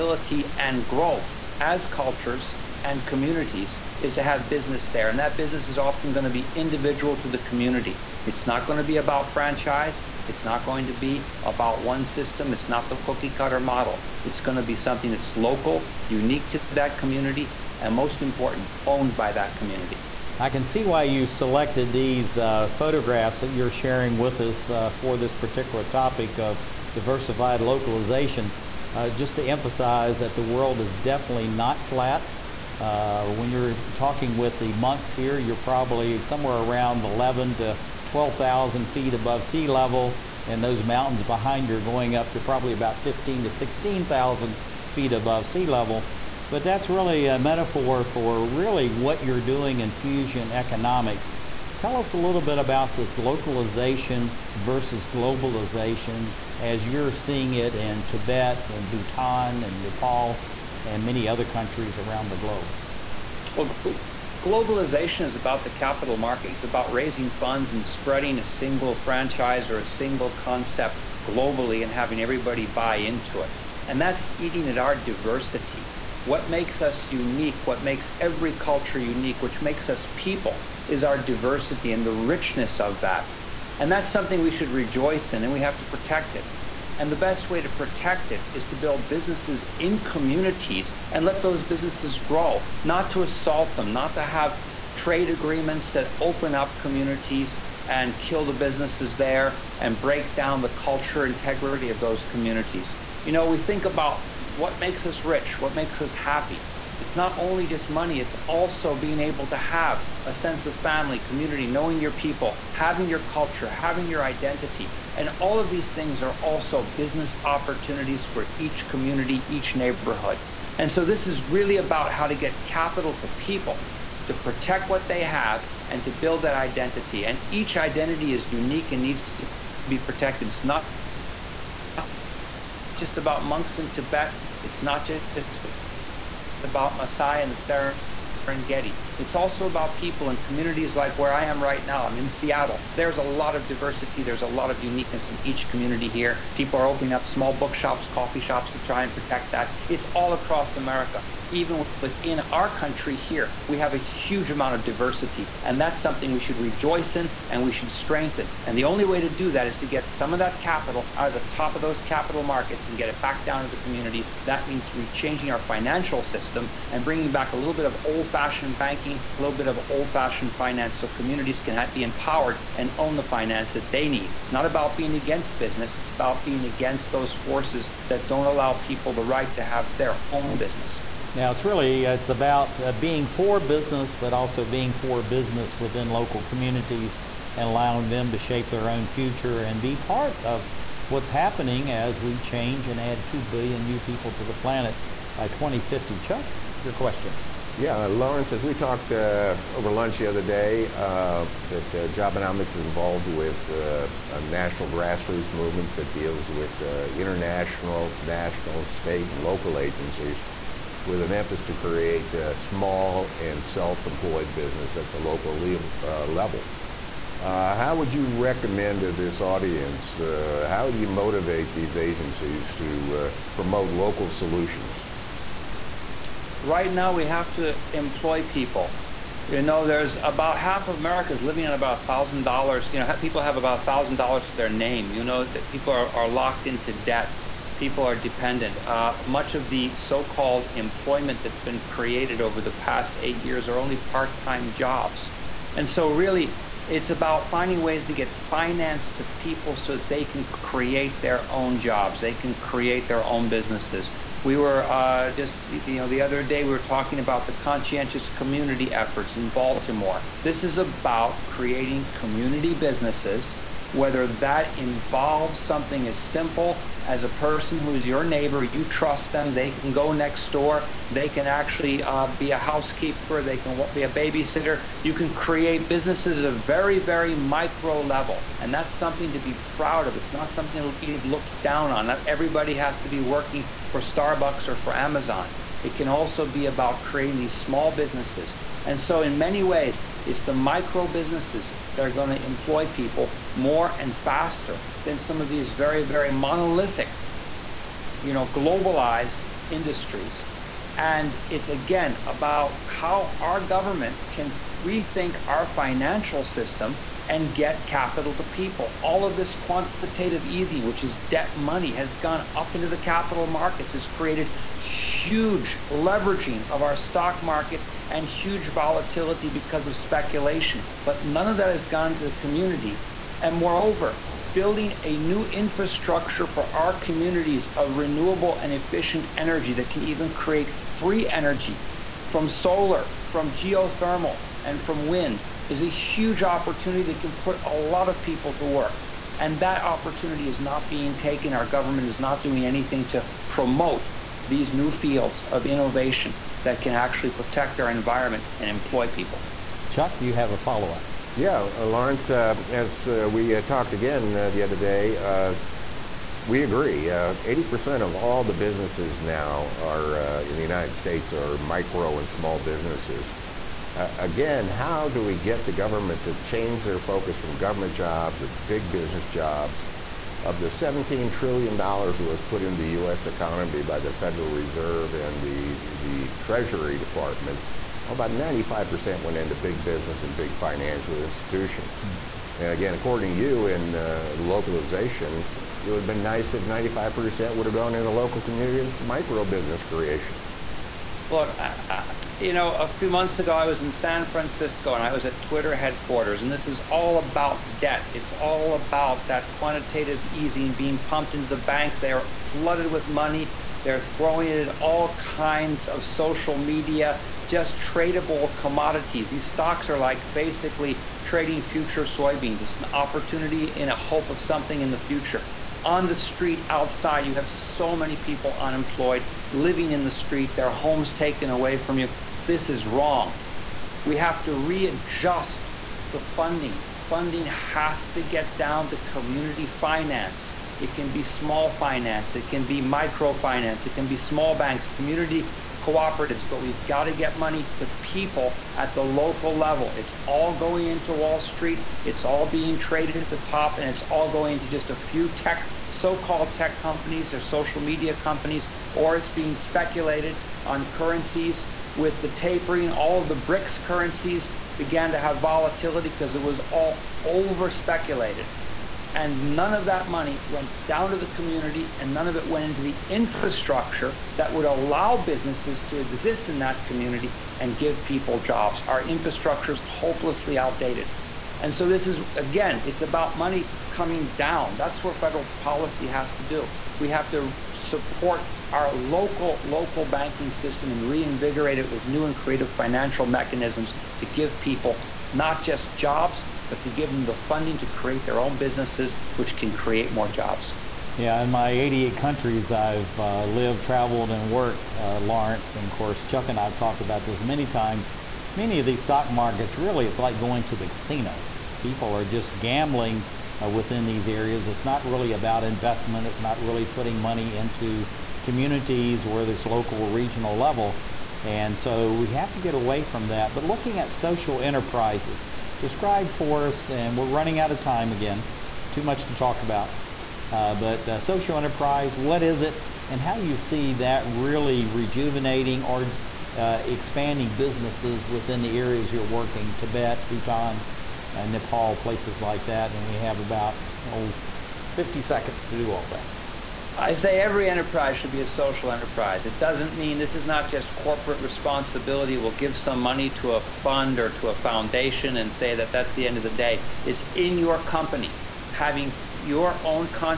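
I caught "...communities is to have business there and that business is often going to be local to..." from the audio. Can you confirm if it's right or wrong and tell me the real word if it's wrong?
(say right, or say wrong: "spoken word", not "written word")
wrong: "individual", not "local".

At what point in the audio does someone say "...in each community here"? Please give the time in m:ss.
2:25.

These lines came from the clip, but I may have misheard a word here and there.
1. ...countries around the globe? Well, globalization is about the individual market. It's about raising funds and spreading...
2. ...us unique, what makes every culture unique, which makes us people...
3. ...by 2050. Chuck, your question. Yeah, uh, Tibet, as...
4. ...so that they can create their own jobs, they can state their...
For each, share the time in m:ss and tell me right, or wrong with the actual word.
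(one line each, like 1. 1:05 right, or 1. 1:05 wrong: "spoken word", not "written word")
1. 1:01 wrong: "capital", not "individual"
2. 1:16 right
3. 3:15 wrong: "Laurence", not "Tibet"
4. 4:09 wrong: "create", not "state".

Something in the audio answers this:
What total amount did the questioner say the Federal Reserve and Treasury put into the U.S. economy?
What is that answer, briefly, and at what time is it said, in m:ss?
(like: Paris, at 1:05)
$17 trillion, at 6:10.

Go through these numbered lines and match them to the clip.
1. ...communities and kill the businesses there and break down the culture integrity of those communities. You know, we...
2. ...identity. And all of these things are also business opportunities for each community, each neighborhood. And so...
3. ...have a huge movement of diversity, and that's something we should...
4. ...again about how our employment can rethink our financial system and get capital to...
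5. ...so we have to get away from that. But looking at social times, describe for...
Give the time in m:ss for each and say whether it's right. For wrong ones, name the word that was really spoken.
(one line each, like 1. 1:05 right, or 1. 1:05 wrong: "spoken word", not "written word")
1. 1:36 right
2. 1:54 right
3. 2:33 wrong: "amount", not "movement"
4. 5:01 wrong: "government", not "employment"
5. 8:31 wrong: "enterprises", not "times".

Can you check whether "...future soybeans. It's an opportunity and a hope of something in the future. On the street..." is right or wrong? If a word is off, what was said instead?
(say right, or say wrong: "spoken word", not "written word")
right.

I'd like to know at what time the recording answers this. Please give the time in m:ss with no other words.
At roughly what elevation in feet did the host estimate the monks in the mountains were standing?
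0:37.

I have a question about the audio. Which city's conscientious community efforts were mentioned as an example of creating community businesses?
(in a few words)
Baltimore.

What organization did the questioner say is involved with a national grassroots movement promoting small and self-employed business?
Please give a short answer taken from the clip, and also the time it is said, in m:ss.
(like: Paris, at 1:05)
Jobenomics, at 3:22.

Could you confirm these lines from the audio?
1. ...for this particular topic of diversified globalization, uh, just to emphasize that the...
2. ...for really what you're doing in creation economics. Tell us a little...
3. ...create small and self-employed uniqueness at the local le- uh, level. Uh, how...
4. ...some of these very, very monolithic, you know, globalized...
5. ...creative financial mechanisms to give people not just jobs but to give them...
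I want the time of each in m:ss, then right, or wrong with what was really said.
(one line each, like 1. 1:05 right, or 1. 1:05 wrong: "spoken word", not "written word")
1. 0:24 wrong: "localization", not "globalization"
2. 0:48 wrong: "fusion", not "creation"
3. 3:31 wrong: "business", not "uniqueness"
4. 4:55 right
5. 8:02 right.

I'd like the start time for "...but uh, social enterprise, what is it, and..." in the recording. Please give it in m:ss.
8:40.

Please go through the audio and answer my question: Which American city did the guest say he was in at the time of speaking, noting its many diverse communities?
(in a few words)
Seattle.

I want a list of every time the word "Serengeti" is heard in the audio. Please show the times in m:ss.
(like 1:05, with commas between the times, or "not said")
2:18.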